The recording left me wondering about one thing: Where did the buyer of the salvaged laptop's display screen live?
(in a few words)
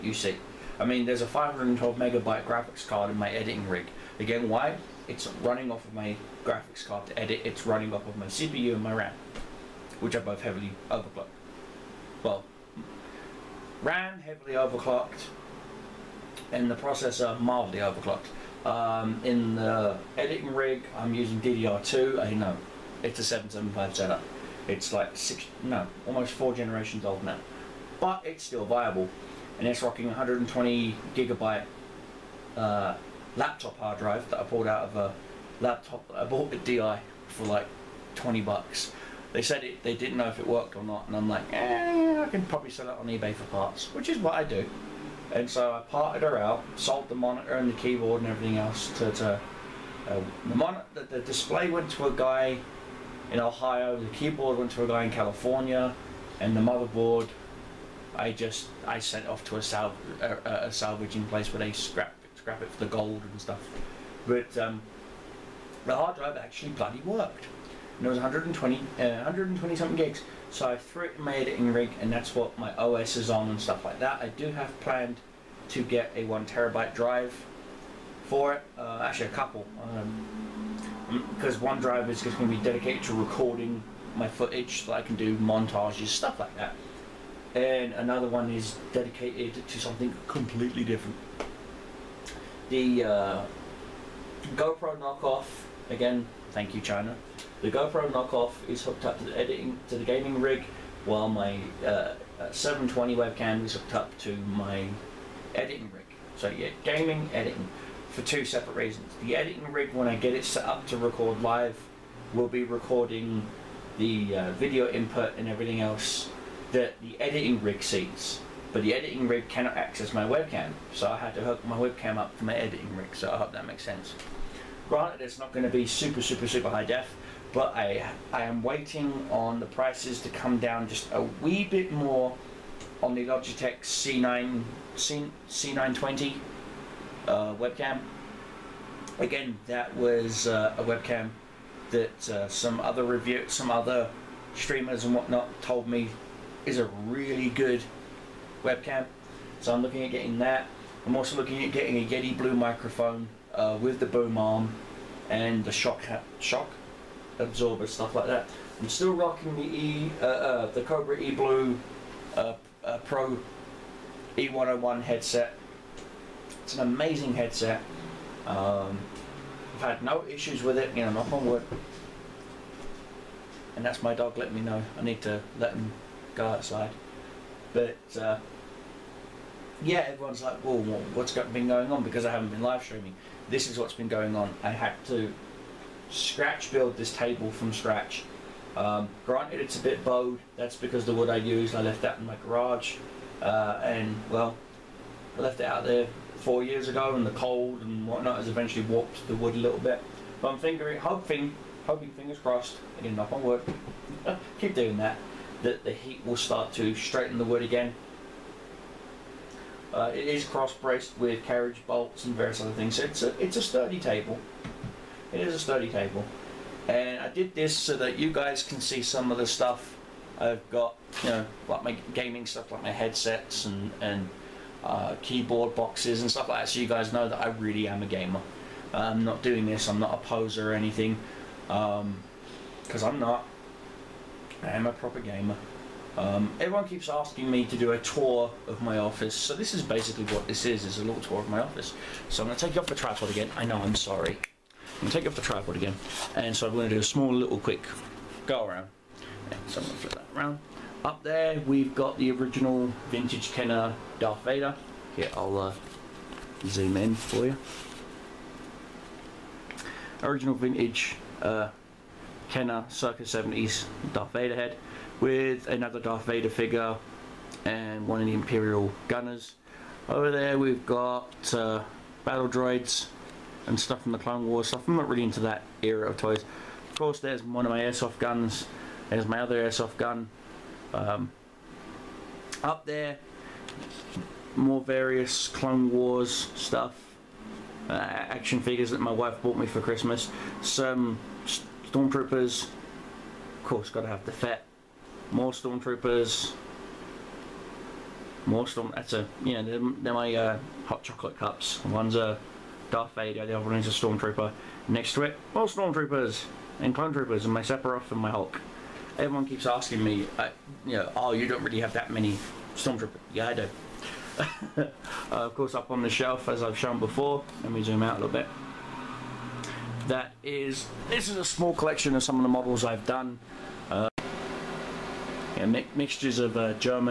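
Ohio.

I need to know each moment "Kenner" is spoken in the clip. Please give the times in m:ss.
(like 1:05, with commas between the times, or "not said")
4:13, 4:22.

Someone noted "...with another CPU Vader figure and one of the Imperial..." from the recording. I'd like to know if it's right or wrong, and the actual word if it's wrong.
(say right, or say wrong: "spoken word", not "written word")
wrong: "Darth", not "CPU".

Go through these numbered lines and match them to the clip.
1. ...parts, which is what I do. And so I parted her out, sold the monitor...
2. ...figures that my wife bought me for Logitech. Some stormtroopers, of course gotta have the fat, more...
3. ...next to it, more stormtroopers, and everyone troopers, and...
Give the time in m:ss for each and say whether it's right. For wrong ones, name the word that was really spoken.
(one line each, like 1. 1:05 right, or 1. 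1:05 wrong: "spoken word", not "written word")
1. 0:43 right
2. 4:48 wrong: "Christmas", not "Logitech"
3. 5:04 wrong: "clone", not "everyone".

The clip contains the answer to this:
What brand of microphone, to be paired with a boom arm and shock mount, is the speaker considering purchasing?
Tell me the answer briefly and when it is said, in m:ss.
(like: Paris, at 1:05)
Yeti Blue, at 2:32.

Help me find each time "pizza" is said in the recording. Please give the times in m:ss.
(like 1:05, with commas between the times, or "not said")
not said.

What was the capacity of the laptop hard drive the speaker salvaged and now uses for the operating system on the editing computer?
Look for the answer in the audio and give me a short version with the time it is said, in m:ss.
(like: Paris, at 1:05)
120 gigabytes, at 0:30.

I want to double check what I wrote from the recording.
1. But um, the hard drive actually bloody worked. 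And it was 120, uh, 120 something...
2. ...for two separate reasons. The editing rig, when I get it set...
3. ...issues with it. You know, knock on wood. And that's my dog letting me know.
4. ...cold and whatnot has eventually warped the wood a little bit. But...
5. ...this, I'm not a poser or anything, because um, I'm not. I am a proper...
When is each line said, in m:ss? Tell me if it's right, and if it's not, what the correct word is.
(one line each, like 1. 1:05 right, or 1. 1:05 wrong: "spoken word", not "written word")
1. 1:04 right
2. 1:48 right
3. 2:50 right
4. 3:17 right
5. 3:49 right.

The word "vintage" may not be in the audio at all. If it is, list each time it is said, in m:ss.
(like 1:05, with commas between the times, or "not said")
4:13, 4:20.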